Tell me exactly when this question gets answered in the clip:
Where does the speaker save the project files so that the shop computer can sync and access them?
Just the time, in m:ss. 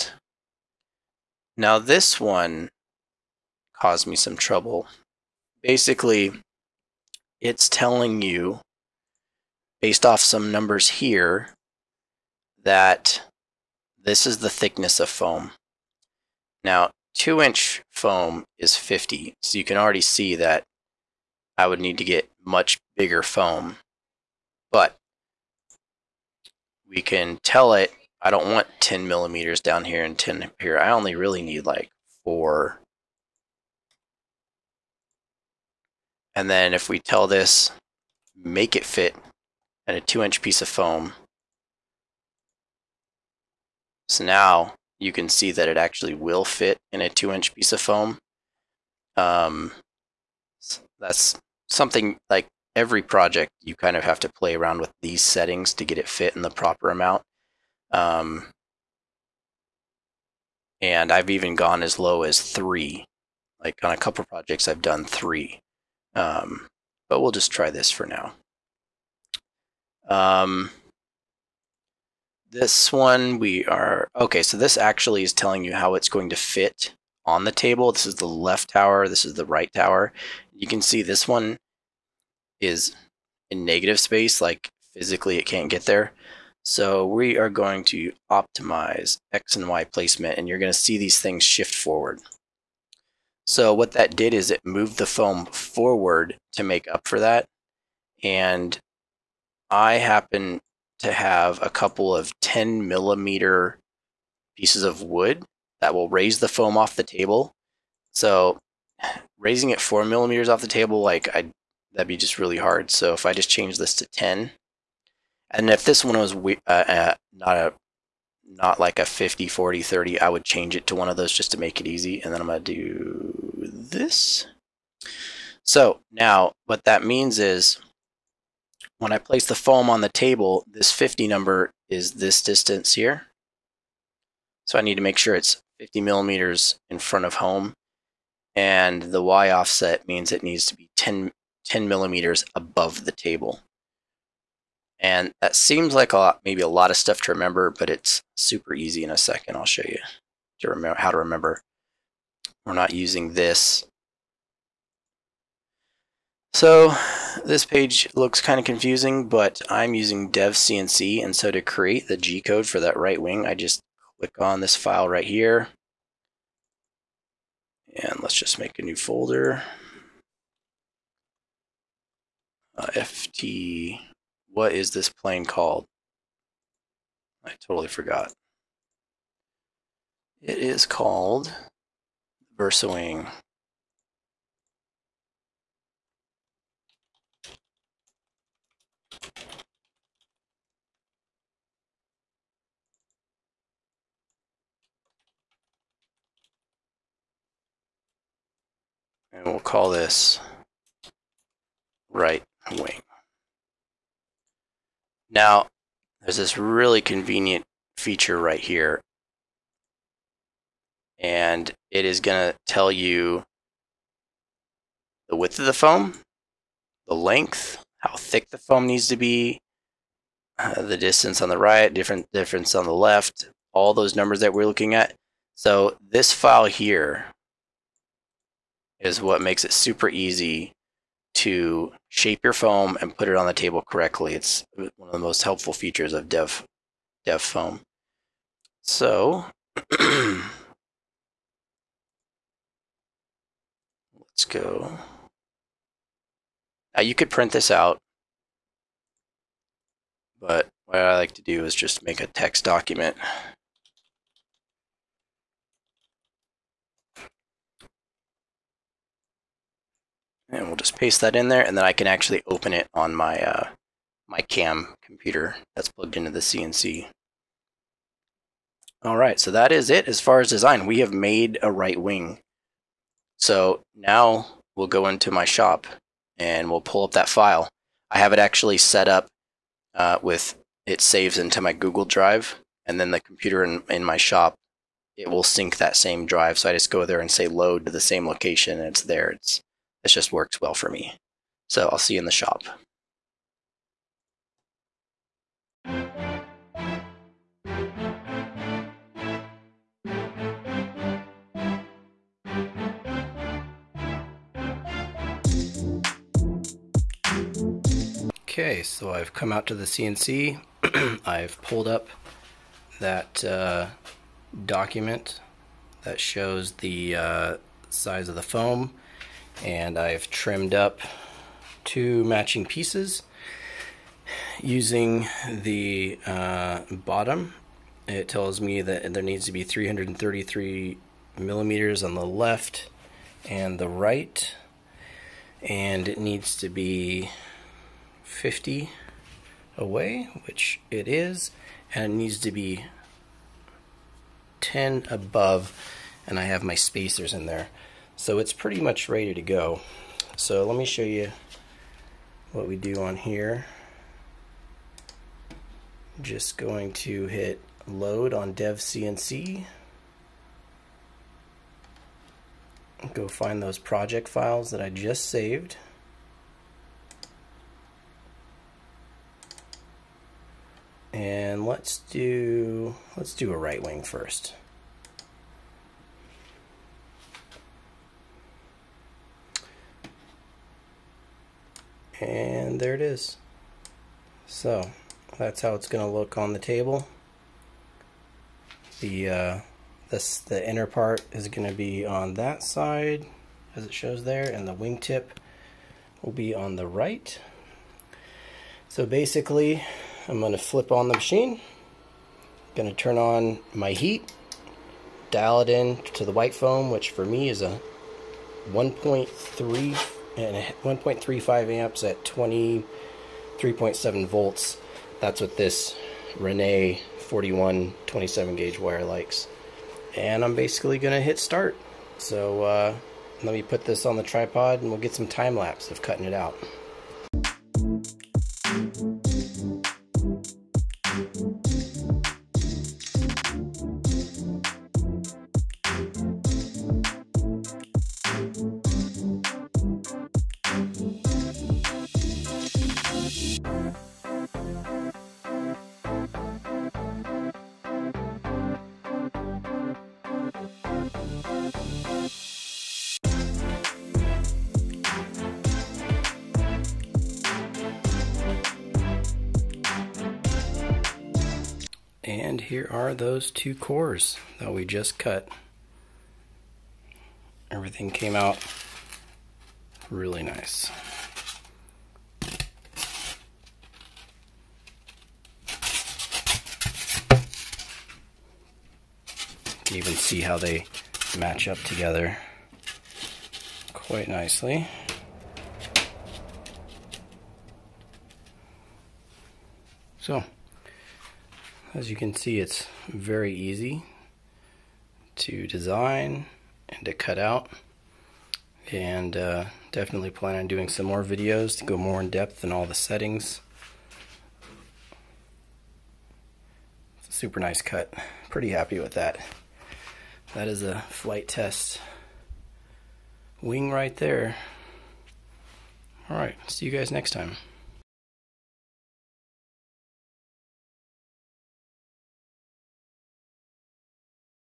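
4:41.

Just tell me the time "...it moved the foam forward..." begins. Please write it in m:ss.
1:34.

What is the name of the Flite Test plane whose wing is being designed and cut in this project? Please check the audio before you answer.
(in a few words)
VersaWing.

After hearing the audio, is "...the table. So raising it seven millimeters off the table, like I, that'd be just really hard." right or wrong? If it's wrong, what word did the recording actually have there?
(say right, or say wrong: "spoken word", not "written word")
wrong: "four", not "seven".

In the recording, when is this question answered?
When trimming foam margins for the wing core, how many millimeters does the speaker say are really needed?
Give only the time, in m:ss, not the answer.
0:31.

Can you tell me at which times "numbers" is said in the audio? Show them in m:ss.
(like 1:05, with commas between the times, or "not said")
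0:10, 2:11, 3:44.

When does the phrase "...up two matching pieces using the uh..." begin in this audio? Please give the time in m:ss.
5:20.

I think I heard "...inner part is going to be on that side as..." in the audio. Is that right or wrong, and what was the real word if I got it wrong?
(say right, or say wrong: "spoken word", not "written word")
right.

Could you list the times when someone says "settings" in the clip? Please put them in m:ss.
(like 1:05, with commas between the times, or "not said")
0:55, 8:22.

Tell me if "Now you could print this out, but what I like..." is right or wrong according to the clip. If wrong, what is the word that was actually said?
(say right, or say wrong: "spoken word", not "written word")
right.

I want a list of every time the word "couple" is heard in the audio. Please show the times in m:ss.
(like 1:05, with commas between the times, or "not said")
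1:03, 1:41.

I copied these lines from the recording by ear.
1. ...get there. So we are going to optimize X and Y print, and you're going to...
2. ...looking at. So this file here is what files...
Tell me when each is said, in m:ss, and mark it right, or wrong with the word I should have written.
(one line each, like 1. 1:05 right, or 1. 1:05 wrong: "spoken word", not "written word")
1. 1:25 wrong: "placement", not "print"
2. 3:44 wrong: "makes", not "files".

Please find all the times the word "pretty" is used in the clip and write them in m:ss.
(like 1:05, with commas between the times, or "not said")
5:48, 8:28.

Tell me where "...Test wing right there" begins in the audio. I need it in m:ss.
8:31.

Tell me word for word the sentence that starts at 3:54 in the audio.
It's one of the most helpful features of Dev, Dev Foam.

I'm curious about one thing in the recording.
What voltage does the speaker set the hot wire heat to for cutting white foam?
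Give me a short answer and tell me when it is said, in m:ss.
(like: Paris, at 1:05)
23.7 volts, at 6:52.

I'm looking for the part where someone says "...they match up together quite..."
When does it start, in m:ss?
8:00.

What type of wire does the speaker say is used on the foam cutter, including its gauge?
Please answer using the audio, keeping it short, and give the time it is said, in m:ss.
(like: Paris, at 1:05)
Rene 41 27 gauge, at 6:56.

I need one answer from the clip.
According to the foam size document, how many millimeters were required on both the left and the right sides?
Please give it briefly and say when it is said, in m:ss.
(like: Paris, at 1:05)
333, at 5:29.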